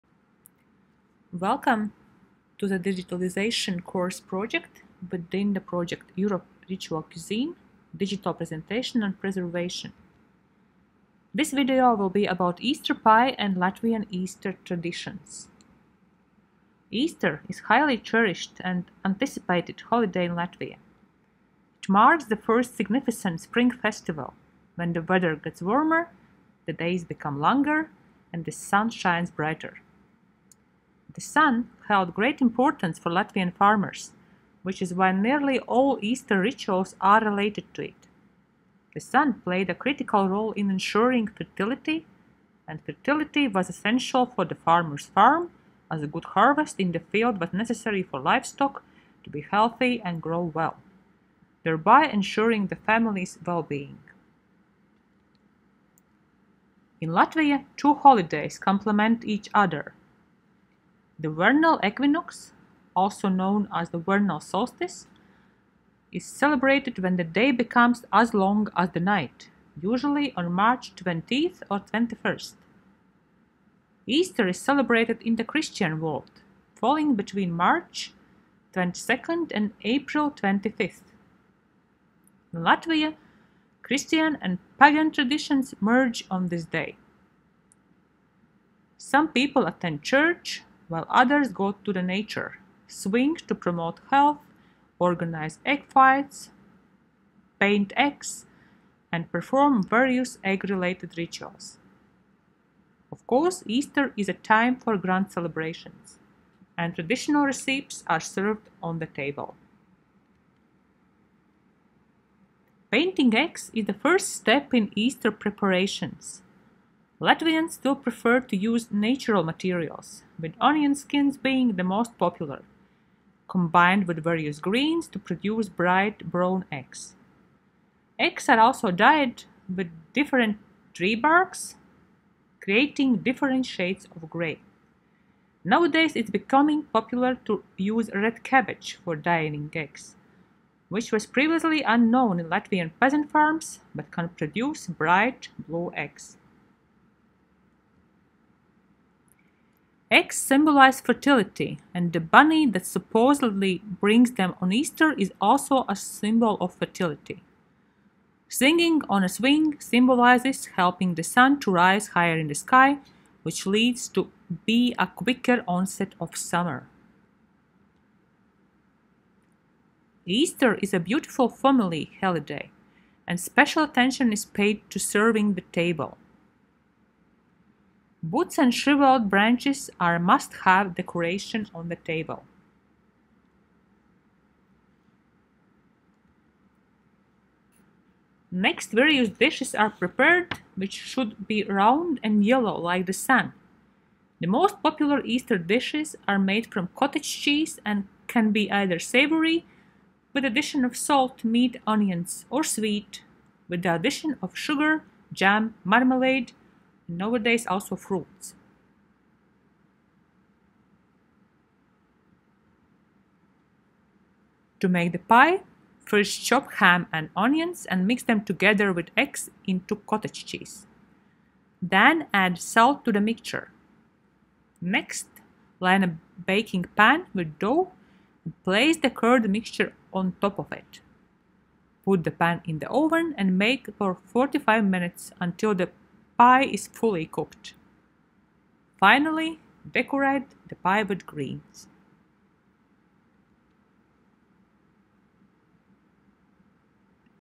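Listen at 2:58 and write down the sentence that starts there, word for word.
Boots and shriveled branches are must-have decoration on the table.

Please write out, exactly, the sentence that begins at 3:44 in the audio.
Next, line a baking pan with dough and place the curd mixture on top of it.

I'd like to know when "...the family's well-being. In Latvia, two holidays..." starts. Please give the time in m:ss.
0:52.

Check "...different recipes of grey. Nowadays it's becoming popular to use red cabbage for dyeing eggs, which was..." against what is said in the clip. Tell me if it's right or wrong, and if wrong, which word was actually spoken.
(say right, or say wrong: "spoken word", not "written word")
wrong: "shades", not "recipes".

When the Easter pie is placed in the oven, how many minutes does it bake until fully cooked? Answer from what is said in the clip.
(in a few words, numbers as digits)
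45 minutes.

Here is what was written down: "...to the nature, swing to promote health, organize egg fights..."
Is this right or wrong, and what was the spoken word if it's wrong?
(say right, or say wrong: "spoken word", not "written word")
right.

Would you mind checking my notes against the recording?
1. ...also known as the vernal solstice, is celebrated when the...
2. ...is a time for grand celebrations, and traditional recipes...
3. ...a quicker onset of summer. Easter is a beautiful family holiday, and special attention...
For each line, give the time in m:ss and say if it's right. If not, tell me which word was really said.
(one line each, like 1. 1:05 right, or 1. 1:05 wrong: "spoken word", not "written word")
1. 1:02 right
2. 1:44 right
3. 2:44 right.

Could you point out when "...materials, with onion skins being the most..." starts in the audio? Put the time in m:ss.
1:59.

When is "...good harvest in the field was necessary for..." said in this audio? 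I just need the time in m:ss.
0:46.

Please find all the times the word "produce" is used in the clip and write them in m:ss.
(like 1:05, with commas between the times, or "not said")
2:05, 2:24.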